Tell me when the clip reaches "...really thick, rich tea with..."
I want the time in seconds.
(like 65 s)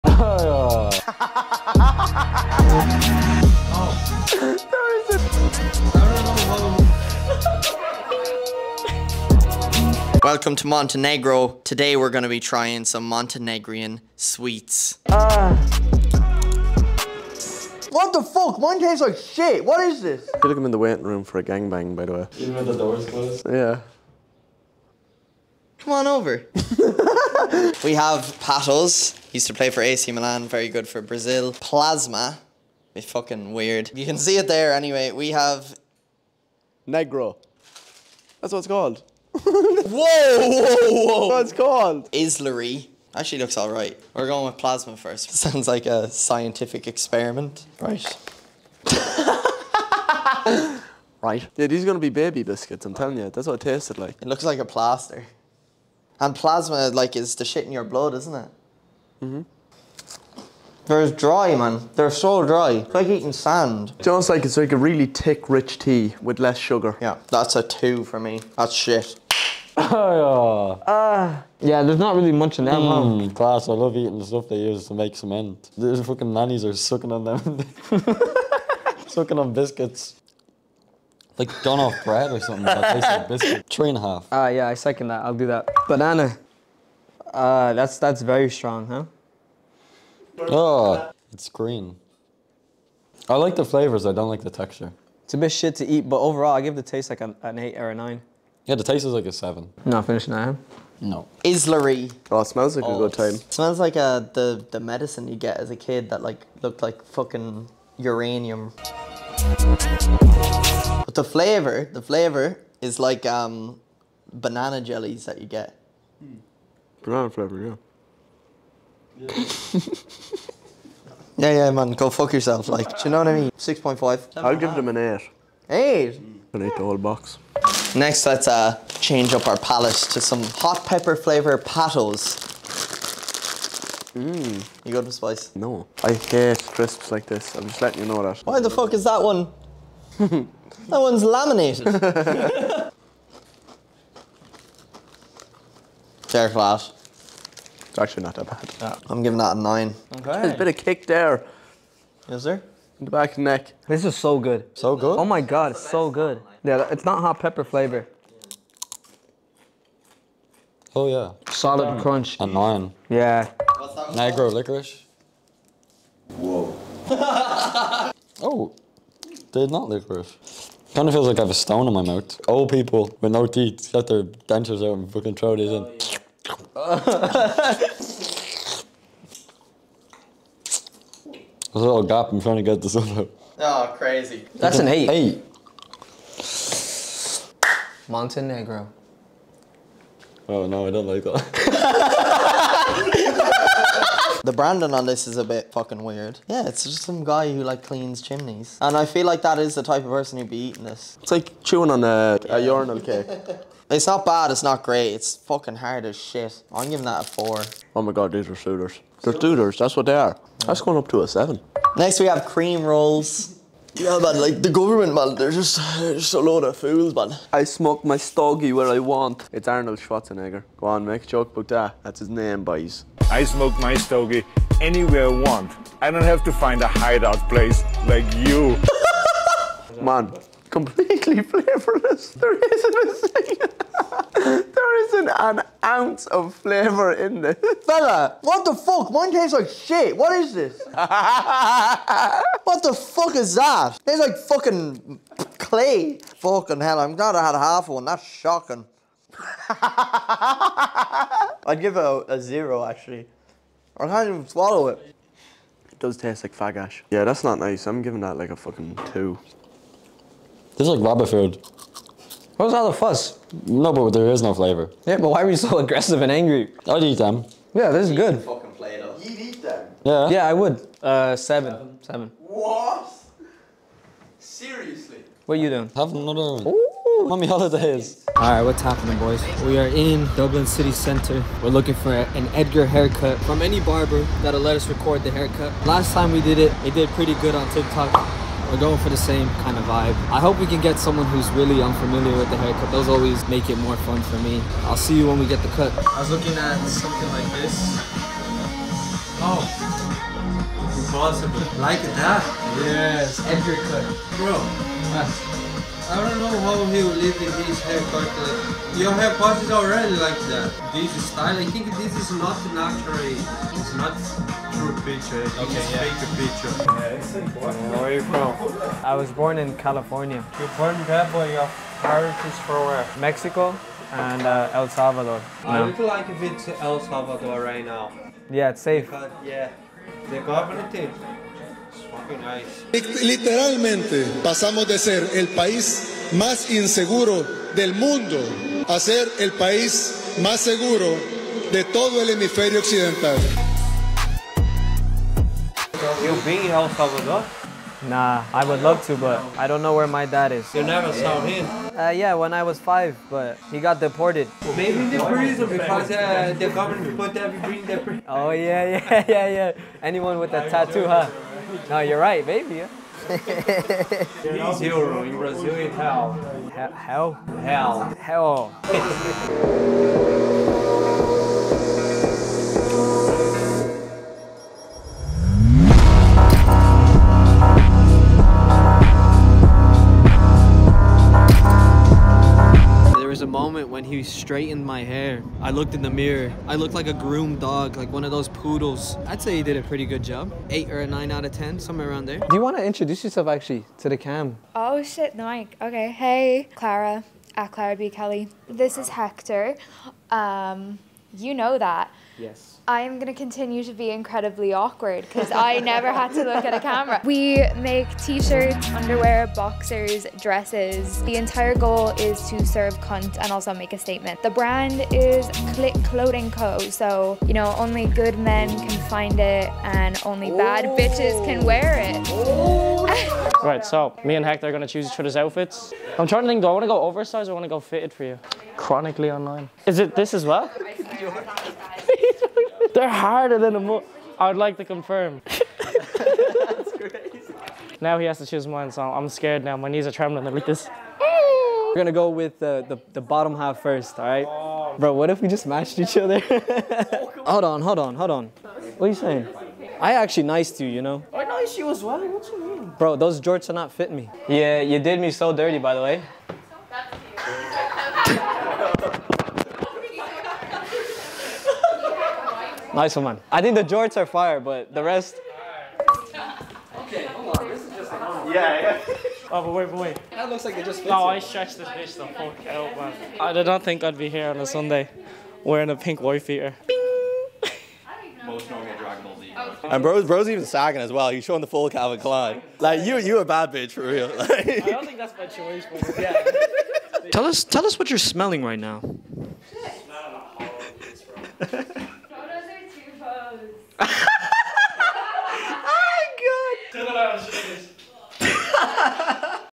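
64 s.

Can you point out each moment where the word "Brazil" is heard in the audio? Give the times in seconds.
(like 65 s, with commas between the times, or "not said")
31 s, 365 s.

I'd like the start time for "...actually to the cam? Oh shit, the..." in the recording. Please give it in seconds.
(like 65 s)
393 s.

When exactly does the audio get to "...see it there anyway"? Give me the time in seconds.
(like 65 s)
34 s.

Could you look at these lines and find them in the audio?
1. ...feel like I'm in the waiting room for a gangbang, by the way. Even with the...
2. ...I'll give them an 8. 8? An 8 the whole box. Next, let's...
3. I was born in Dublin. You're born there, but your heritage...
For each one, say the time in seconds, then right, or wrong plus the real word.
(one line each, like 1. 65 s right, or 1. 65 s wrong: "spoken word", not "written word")
1. 20 s right
2. 124 s right
3. 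319 s wrong: "California", not "Dublin".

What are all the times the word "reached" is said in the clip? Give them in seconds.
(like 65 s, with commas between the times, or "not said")
not said.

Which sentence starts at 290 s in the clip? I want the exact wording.
I hope we can get someone who's really unfamiliar with the haircut.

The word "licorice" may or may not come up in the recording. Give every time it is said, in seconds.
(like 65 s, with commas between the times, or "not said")
164 s, 169 s.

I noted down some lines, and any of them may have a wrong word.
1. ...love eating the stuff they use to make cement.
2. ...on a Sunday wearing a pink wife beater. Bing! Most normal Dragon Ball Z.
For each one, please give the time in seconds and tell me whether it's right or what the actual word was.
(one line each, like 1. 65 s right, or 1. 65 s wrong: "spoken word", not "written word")
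1. 73 s right
2. 474 s right.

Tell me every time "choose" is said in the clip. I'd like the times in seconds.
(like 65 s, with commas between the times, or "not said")
424 s, 438 s.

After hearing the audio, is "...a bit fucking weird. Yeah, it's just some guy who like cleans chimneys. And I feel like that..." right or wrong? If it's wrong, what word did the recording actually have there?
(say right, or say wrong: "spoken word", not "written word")
right.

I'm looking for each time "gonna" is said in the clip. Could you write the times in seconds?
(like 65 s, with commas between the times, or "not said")
51 s, 441 s.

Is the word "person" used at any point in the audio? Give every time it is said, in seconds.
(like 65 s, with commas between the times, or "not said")
200 s.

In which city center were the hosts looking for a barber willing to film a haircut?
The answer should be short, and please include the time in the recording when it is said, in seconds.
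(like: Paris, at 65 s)
Dublin, at 280 s.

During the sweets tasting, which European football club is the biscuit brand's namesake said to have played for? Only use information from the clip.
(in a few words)
AC Milan.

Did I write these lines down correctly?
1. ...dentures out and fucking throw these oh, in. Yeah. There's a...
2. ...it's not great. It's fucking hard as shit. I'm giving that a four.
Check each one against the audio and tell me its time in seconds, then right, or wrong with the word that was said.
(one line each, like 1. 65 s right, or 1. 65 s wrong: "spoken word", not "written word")
1. 174 s right
2. 204 s right.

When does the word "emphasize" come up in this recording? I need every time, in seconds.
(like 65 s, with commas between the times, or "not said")
not said.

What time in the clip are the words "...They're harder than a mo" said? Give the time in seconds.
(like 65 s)
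432 s.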